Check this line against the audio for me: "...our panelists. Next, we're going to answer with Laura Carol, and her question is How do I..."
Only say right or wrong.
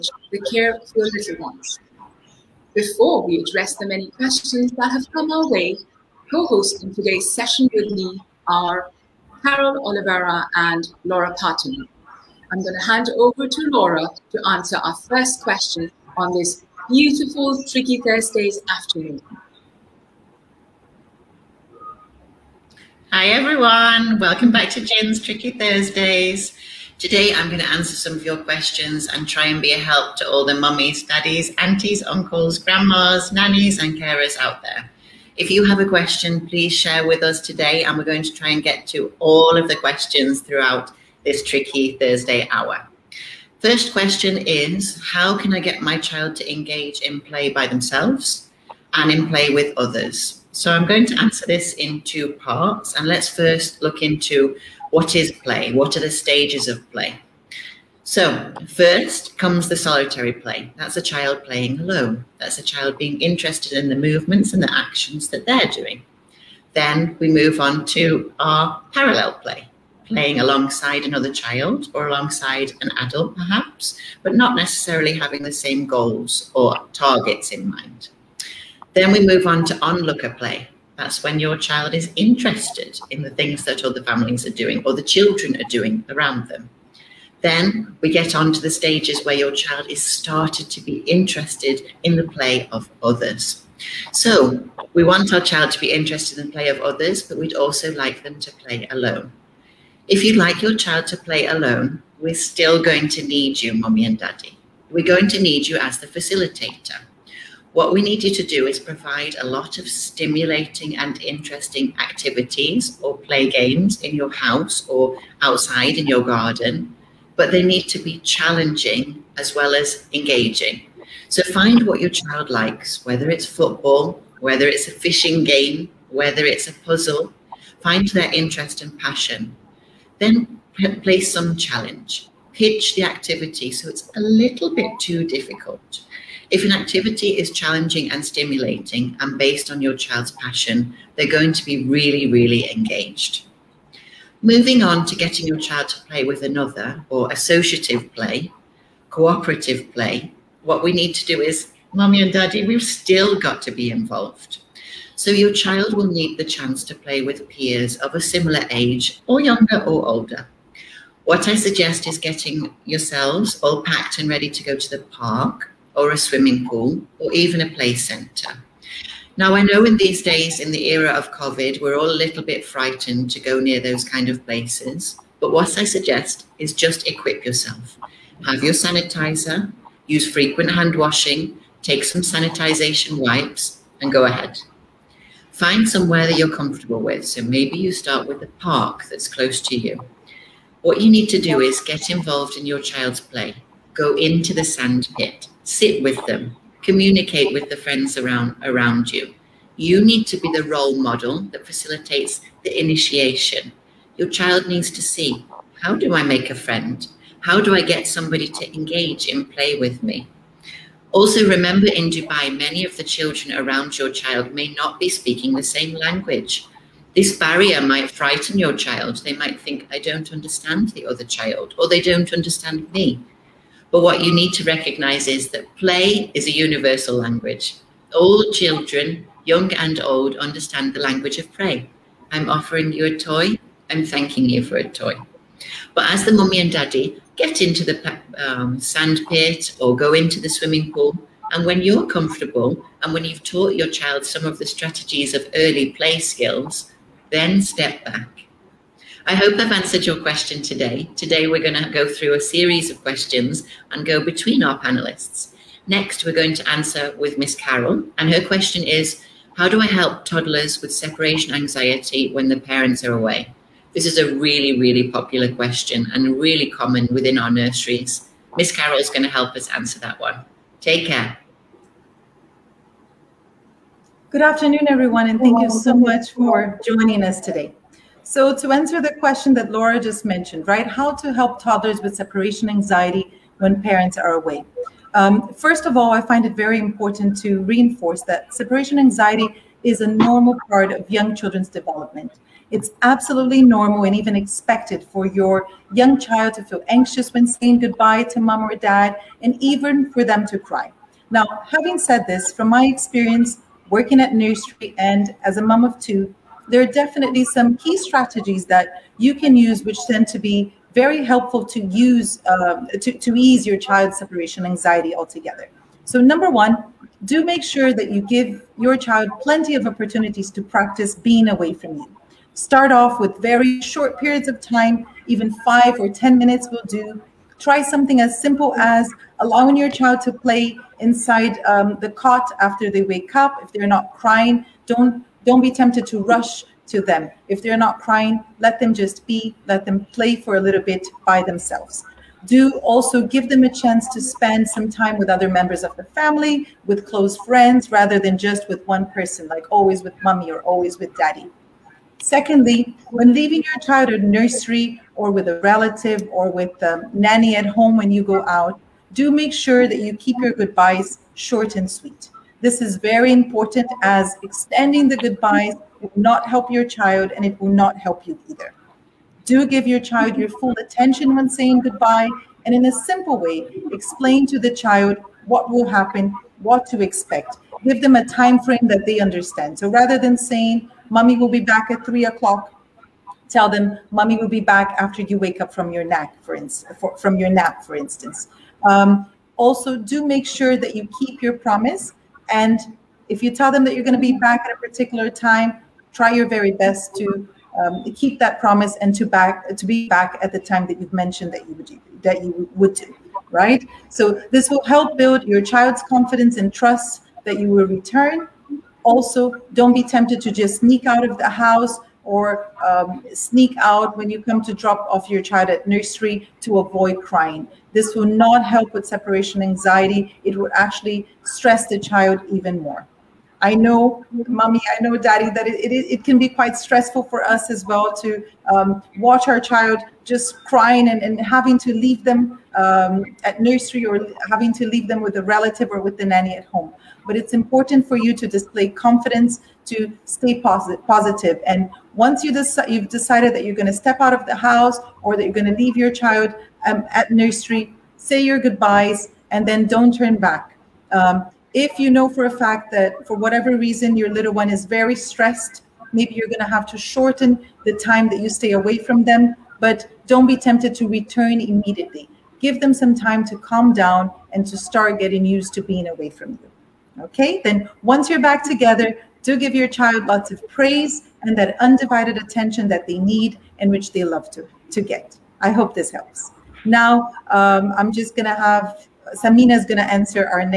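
wrong.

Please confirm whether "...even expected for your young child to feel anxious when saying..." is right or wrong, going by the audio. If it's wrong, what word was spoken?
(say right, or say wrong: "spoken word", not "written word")
right.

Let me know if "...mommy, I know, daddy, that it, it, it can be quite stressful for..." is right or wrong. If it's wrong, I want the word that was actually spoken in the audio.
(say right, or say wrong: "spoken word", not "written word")
right.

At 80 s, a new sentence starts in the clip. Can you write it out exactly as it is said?
That's when your child is interested in the things that other families are doing or the children are doing around them.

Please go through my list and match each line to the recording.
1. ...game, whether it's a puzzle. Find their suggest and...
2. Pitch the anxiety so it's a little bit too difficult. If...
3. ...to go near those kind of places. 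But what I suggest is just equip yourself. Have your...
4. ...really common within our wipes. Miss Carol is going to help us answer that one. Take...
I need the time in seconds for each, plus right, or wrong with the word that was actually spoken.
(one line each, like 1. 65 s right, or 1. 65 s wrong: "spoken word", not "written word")
1. 125 s wrong: "interest", not "suggest"
2. 132 s wrong: "activity", not "anxiety"
3. 173 s right
4. 266 s wrong: "nurseries", not "wipes".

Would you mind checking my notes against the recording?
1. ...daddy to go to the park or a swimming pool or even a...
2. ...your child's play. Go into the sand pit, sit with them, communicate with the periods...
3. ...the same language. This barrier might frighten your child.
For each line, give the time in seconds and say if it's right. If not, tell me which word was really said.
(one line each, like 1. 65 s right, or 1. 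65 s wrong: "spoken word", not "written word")
1. 164 s wrong: "ready", not "daddy"
2. 192 s wrong: "friends", not "periods"
3. 215 s right.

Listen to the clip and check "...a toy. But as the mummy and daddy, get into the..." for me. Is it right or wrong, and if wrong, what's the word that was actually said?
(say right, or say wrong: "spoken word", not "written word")
right.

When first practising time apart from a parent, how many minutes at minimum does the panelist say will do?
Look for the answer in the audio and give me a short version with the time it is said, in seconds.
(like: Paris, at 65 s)
5, at 325 s.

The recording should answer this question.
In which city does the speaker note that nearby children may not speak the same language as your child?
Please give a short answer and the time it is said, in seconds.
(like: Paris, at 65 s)
Dubai, at 212 s.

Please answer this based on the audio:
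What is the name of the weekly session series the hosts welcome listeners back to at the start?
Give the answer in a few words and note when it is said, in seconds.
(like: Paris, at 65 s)
Tricky Thursdays, at 25 s.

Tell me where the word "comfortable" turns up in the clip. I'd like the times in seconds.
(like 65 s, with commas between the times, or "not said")
186 s, 242 s.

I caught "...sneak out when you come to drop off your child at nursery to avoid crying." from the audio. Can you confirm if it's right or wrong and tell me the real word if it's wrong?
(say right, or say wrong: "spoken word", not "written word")
right.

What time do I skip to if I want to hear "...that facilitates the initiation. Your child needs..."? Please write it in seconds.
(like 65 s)
201 s.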